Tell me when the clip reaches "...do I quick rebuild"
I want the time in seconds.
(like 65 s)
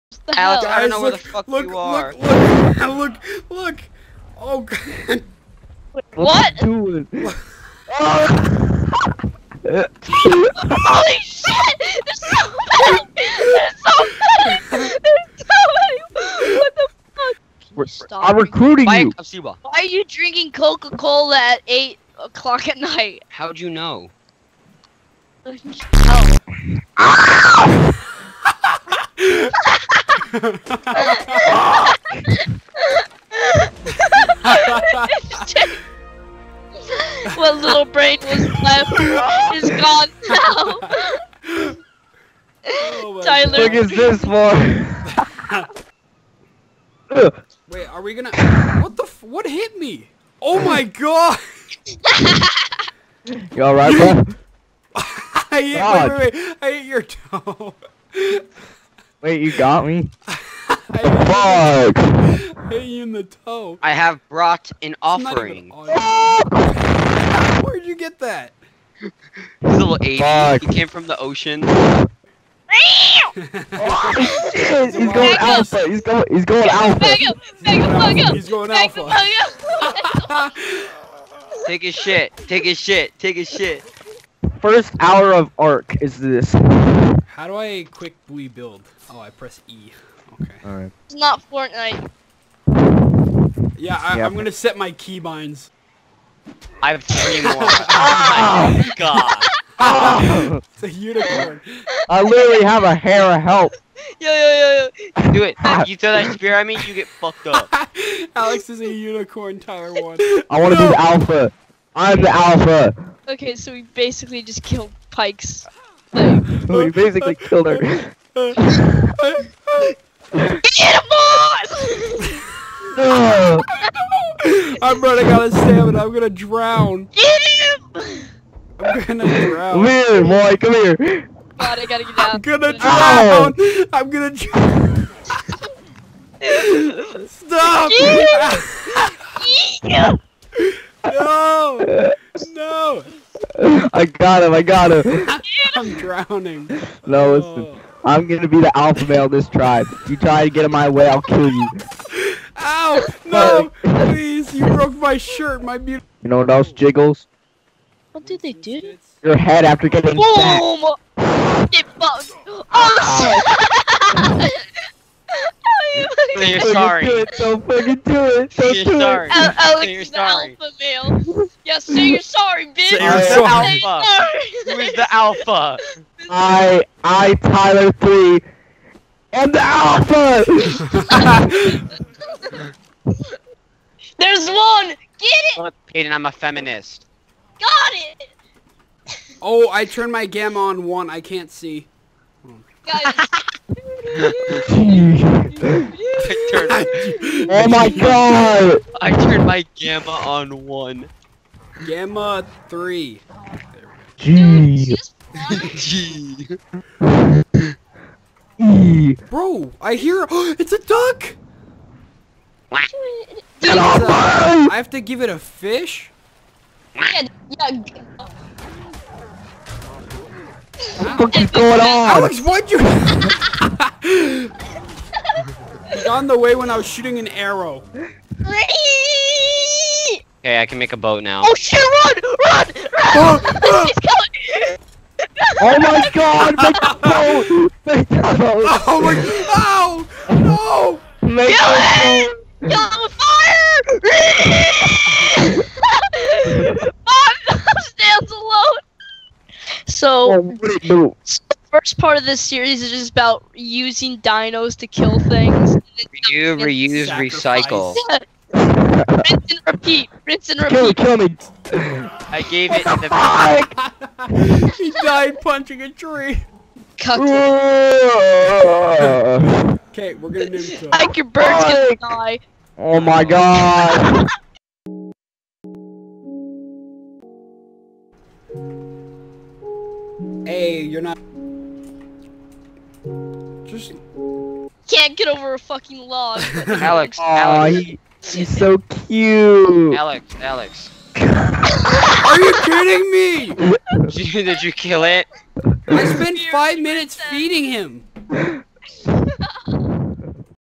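87 s.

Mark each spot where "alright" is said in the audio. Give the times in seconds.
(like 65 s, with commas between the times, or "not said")
53 s, 90 s.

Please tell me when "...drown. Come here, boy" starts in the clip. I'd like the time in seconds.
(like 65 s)
129 s.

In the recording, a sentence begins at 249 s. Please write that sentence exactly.
So, oh, first part of this series is just about using dinos to kill things.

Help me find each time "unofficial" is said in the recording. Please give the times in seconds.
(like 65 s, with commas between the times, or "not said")
not said.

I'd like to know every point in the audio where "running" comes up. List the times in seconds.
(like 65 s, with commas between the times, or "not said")
125 s.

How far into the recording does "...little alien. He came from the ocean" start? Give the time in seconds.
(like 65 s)
69 s.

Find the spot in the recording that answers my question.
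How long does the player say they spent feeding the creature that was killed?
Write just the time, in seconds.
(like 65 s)
296 s.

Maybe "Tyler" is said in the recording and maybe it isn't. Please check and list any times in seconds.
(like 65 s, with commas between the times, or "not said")
43 s, 109 s, 177 s.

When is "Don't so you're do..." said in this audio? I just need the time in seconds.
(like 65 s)
168 s.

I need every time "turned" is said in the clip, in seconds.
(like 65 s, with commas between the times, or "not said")
189 s, 194 s, 199 s.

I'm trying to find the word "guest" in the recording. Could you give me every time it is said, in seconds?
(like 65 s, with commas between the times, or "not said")
not said.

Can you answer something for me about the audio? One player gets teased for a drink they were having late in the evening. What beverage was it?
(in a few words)
Coca-Cola.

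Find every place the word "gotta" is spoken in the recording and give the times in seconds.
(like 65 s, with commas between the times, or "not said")
131 s.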